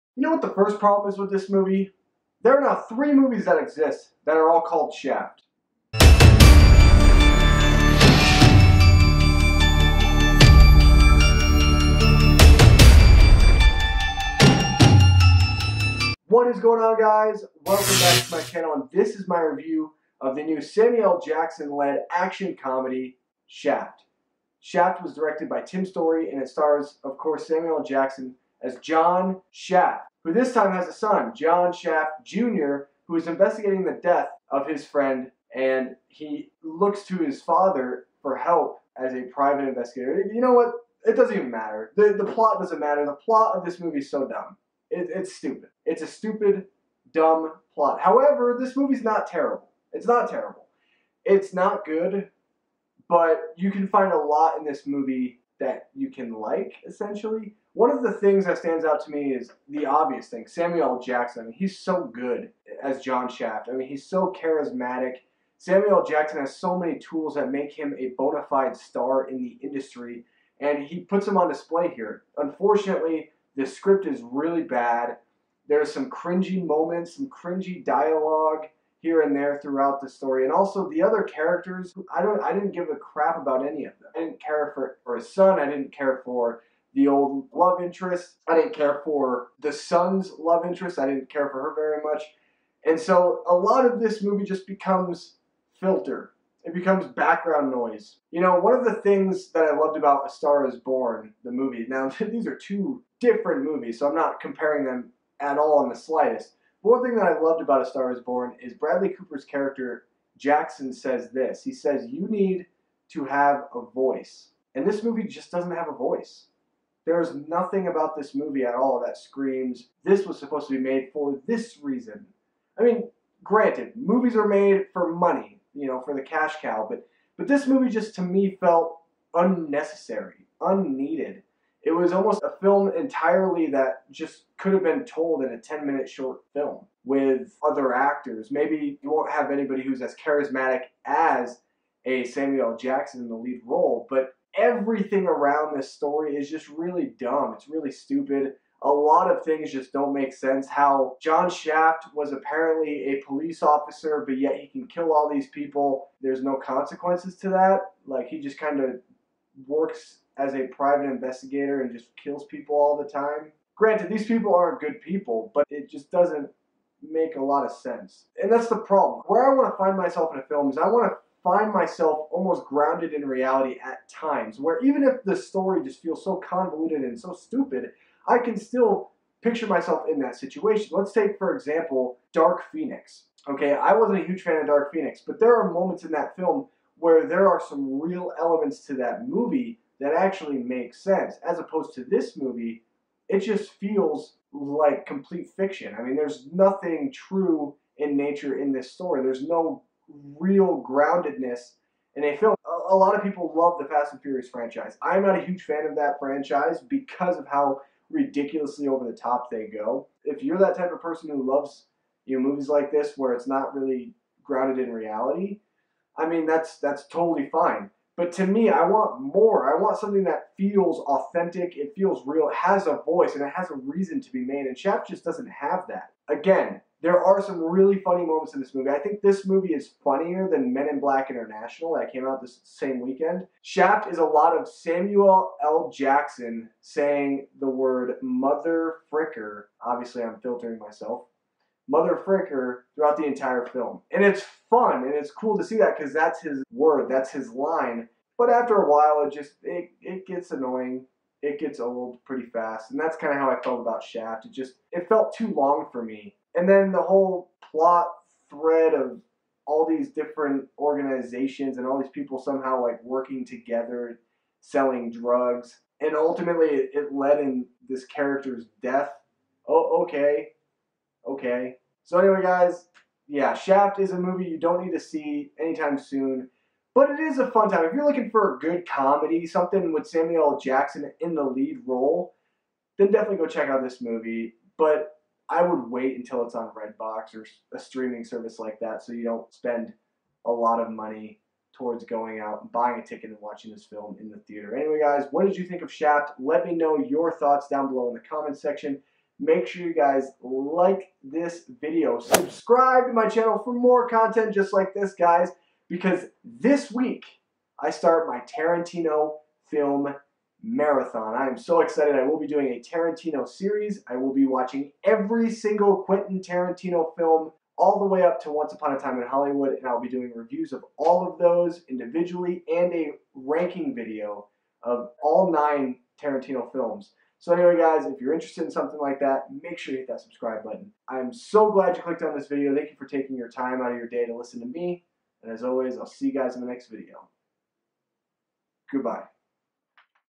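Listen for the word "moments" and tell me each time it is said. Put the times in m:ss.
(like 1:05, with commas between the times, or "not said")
1:16, 3:05, 3:48.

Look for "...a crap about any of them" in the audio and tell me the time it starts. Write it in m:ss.
1:22.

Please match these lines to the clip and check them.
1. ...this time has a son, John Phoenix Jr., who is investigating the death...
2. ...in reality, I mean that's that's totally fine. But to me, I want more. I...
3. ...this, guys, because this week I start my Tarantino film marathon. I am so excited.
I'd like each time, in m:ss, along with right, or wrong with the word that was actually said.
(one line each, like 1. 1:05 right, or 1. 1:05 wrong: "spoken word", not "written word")
1. 0:30 wrong: "Shaft", not "Phoenix"
2. 3:34 right
3. 5:04 right.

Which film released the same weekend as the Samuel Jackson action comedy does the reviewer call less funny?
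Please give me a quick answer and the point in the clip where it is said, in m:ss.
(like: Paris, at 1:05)
Men in Black International, at 3:50.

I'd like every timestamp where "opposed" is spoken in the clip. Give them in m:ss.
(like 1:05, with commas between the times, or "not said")
3:11.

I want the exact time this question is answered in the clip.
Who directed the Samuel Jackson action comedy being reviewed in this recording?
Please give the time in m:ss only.
0:25.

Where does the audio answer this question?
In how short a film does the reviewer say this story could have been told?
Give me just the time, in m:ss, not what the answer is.
2:15.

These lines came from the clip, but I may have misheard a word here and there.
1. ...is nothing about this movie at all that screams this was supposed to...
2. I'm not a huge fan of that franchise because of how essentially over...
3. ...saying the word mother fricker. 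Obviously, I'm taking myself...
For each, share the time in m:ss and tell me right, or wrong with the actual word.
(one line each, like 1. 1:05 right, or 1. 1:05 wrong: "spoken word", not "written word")
1. 1:57 right
2. 3:25 wrong: "ridiculously", not "essentially"
3. 3:56 wrong: "filtering", not "taking".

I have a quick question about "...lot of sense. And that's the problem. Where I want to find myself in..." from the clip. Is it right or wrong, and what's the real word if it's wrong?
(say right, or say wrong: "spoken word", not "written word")
right.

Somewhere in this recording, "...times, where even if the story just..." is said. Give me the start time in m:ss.
2:54.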